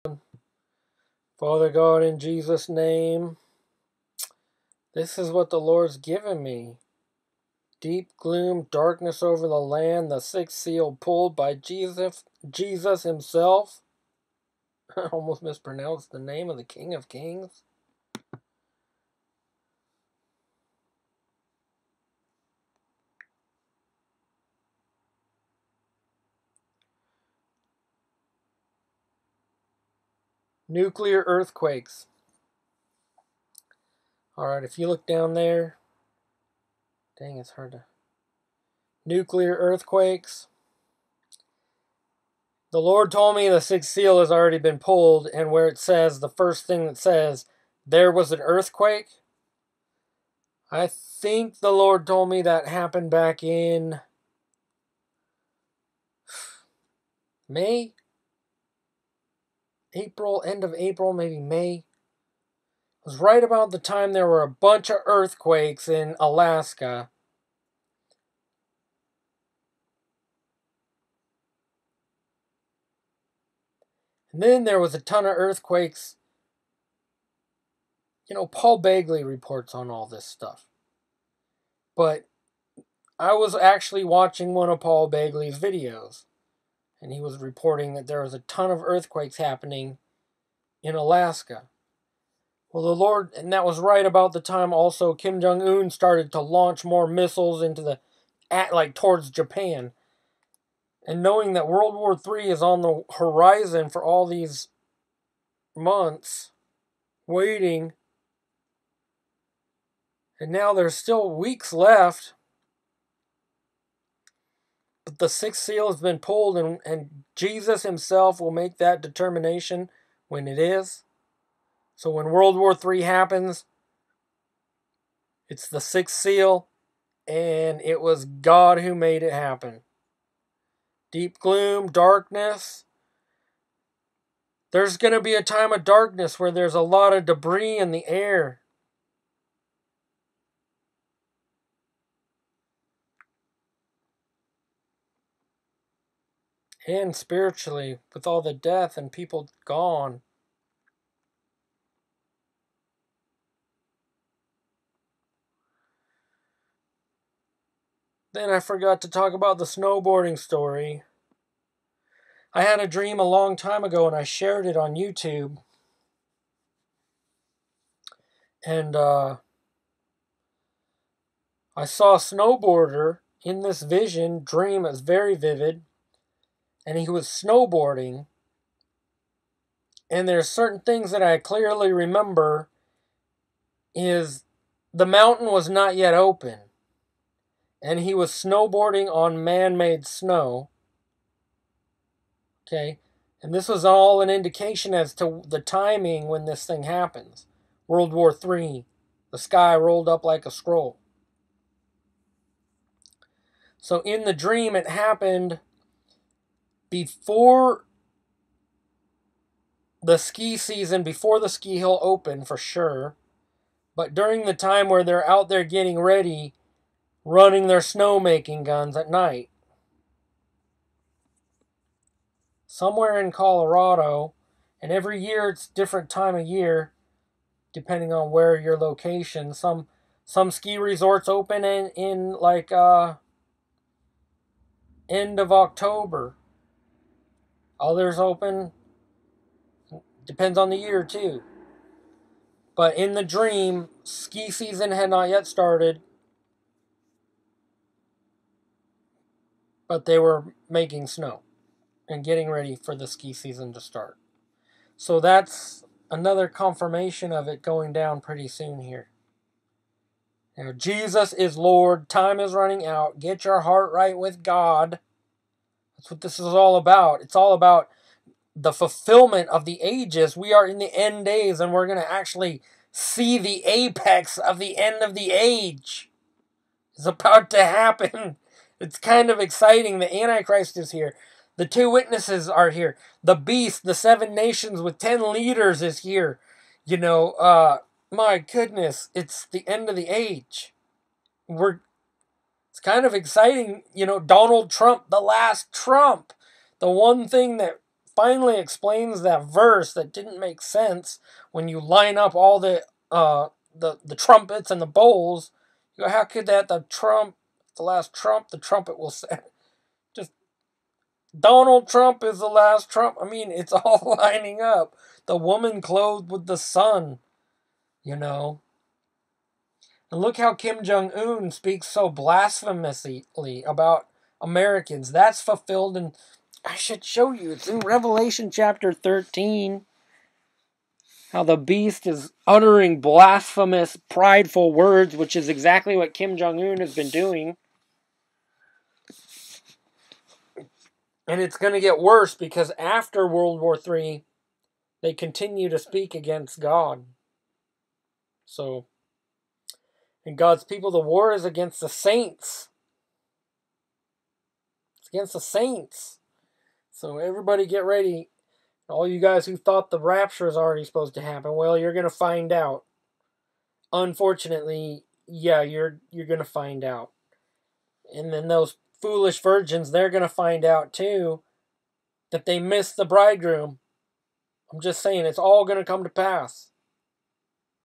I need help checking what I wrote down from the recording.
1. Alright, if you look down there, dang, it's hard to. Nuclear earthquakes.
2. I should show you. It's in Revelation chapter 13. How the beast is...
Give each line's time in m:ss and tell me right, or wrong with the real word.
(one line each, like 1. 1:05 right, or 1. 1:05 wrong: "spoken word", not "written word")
1. 0:34 right
2. 5:26 right.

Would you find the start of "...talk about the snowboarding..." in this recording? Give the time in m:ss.
2:39.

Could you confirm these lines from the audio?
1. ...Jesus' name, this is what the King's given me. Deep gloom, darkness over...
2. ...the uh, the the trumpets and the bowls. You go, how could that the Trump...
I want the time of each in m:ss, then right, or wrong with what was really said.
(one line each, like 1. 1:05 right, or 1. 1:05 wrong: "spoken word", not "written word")
1. 0:02 wrong: "Lord", not "King"
2. 5:02 right.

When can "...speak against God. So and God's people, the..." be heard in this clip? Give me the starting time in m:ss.
5:45.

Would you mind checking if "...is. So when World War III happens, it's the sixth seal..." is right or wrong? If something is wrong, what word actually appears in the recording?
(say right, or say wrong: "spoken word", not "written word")
right.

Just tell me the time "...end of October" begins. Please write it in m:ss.
3:55.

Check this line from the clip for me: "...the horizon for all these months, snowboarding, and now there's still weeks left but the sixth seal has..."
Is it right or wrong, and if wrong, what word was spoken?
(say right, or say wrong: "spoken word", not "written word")
wrong: "waiting", not "snowboarding".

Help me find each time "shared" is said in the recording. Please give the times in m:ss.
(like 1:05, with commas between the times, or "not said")
2:44.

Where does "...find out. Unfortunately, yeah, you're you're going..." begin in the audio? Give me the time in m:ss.
6:02.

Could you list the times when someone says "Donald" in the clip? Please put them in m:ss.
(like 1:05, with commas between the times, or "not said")
4:54, 5:11.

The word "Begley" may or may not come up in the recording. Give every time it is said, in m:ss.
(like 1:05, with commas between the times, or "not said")
1:18, 1:25.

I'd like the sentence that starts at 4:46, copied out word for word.
You know, uh, my goodness, it's the end of the age.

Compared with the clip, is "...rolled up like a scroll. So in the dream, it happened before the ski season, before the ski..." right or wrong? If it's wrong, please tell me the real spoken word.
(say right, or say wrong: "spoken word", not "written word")
right.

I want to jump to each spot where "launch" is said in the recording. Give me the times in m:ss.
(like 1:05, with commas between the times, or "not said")
1:36.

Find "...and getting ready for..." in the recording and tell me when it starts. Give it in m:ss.
4:12.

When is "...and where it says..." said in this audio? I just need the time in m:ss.
0:45.